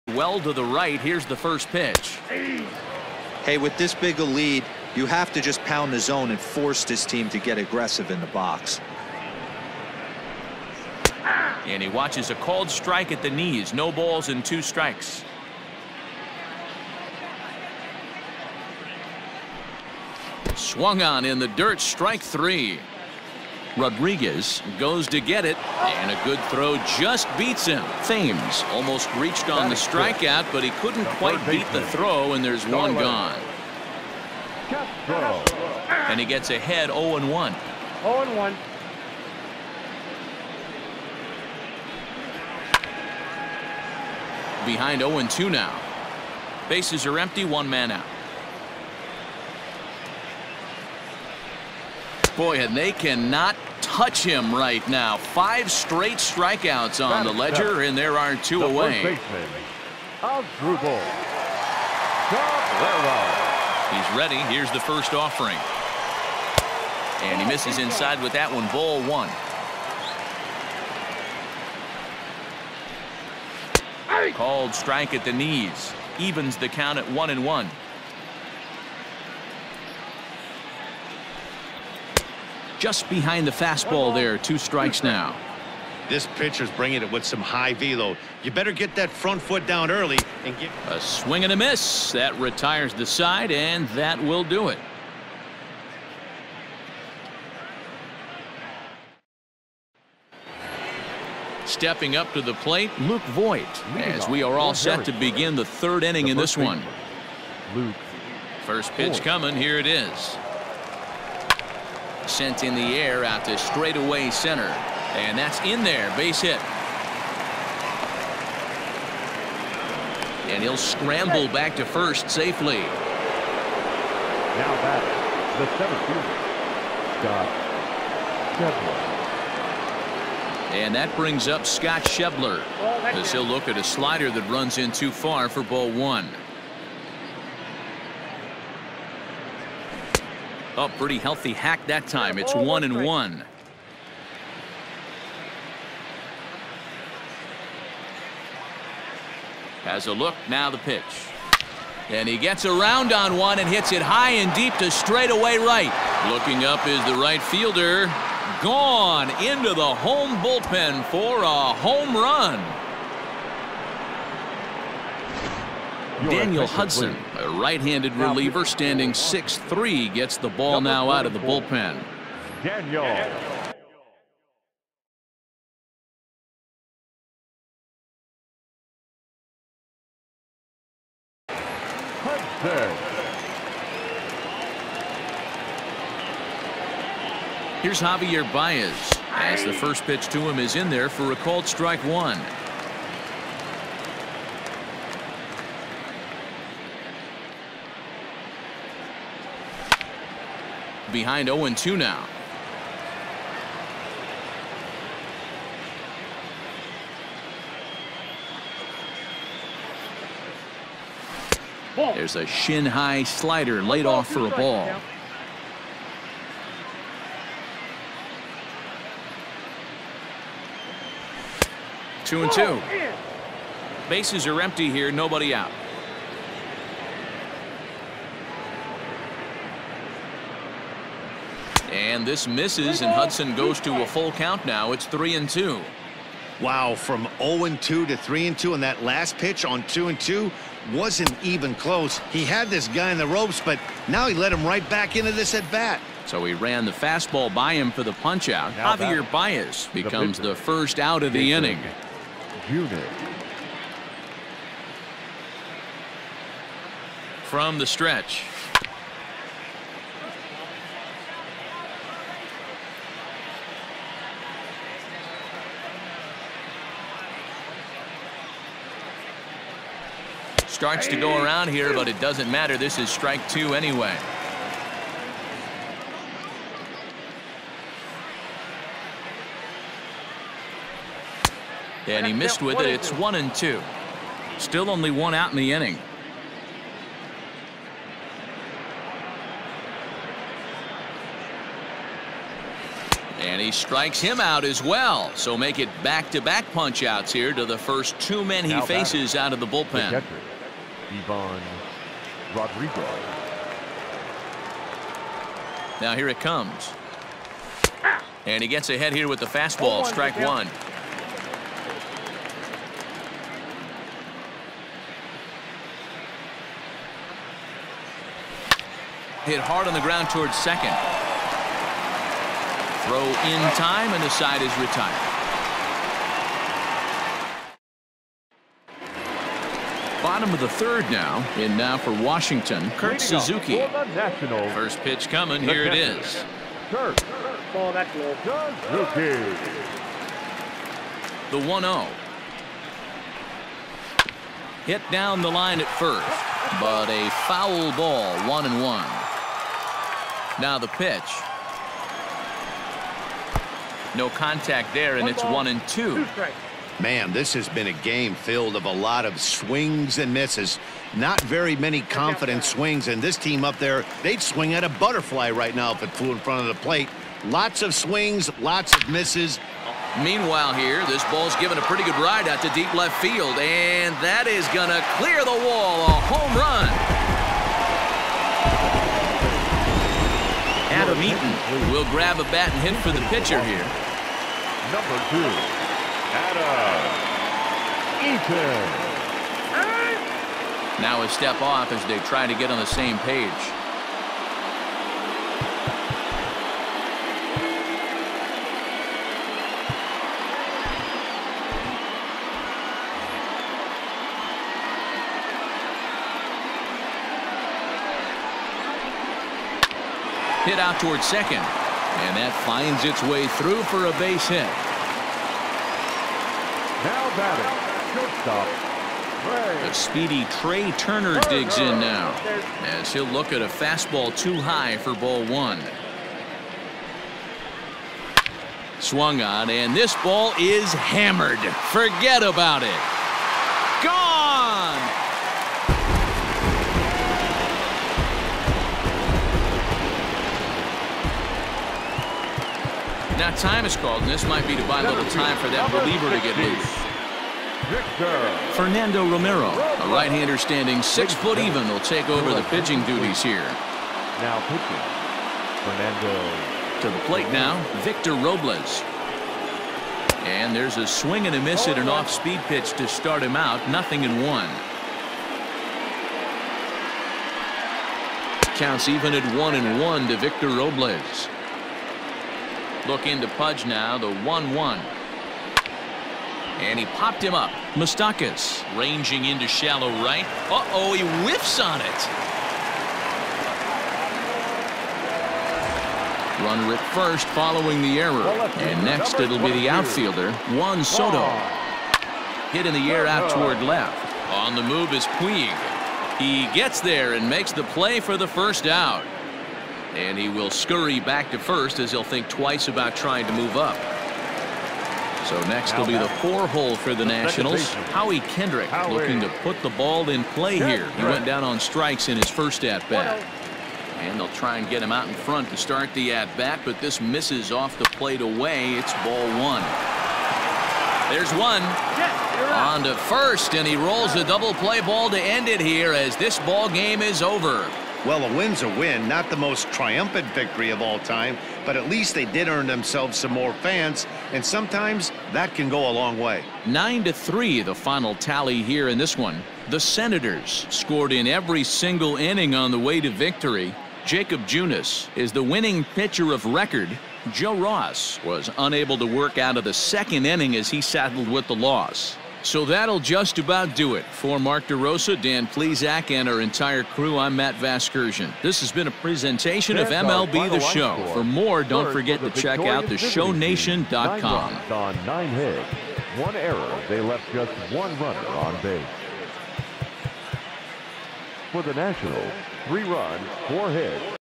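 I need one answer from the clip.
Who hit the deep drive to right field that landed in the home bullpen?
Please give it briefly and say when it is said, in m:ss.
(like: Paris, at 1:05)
Scott Schebler, at 2:11.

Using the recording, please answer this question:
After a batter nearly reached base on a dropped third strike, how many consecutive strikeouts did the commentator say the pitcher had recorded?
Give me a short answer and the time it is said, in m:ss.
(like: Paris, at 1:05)
5, at 0:55.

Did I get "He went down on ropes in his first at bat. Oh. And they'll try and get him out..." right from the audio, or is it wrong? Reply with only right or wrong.
wrong.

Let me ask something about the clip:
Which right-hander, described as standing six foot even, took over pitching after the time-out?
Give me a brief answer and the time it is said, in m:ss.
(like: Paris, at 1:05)
Fernando Romero, at 7:28.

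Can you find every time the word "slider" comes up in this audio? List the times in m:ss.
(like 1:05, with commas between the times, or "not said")
2:13, 3:33.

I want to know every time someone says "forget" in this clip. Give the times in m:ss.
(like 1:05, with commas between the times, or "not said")
7:11, 9:22.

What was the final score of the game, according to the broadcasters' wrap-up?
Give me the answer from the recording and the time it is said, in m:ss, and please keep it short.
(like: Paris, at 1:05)
9 to 3, at 8:56.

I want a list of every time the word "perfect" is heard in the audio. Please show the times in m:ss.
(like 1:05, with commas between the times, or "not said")
not said.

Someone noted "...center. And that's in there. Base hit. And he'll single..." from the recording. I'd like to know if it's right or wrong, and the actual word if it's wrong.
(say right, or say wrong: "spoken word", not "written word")
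wrong: "scramble", not "single".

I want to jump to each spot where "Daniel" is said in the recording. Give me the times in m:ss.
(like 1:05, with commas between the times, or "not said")
2:46, 2:52.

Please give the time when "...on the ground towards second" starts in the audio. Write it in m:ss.
5:19.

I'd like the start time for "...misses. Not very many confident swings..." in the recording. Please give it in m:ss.
6:00.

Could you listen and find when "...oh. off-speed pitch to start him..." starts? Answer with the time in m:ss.
7:42.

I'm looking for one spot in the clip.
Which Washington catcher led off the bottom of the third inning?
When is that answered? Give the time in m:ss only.
5:32.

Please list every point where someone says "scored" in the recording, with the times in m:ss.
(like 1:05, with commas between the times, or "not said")
9:00.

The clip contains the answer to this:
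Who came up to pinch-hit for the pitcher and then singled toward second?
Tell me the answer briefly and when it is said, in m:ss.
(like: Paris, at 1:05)
Adam Eaton, at 6:20.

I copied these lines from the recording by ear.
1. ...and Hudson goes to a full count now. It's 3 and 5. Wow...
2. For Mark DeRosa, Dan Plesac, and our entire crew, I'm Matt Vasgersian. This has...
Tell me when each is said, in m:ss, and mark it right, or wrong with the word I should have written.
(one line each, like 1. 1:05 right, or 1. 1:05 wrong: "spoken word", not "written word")
1. 3:53 wrong: "2", not "5"
2. 9:14 right.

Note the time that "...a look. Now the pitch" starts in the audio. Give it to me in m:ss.
2:30.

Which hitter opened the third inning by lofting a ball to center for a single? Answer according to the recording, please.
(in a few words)
Luke Voit.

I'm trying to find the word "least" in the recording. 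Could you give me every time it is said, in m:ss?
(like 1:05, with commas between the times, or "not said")
8:52.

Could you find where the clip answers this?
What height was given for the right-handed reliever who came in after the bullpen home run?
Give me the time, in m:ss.
2:49.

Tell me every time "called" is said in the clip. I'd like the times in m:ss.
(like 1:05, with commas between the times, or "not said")
0:12, 1:14, 3:11, 7:23.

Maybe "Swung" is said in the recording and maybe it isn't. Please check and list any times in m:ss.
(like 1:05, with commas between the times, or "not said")
0:20, 7:08.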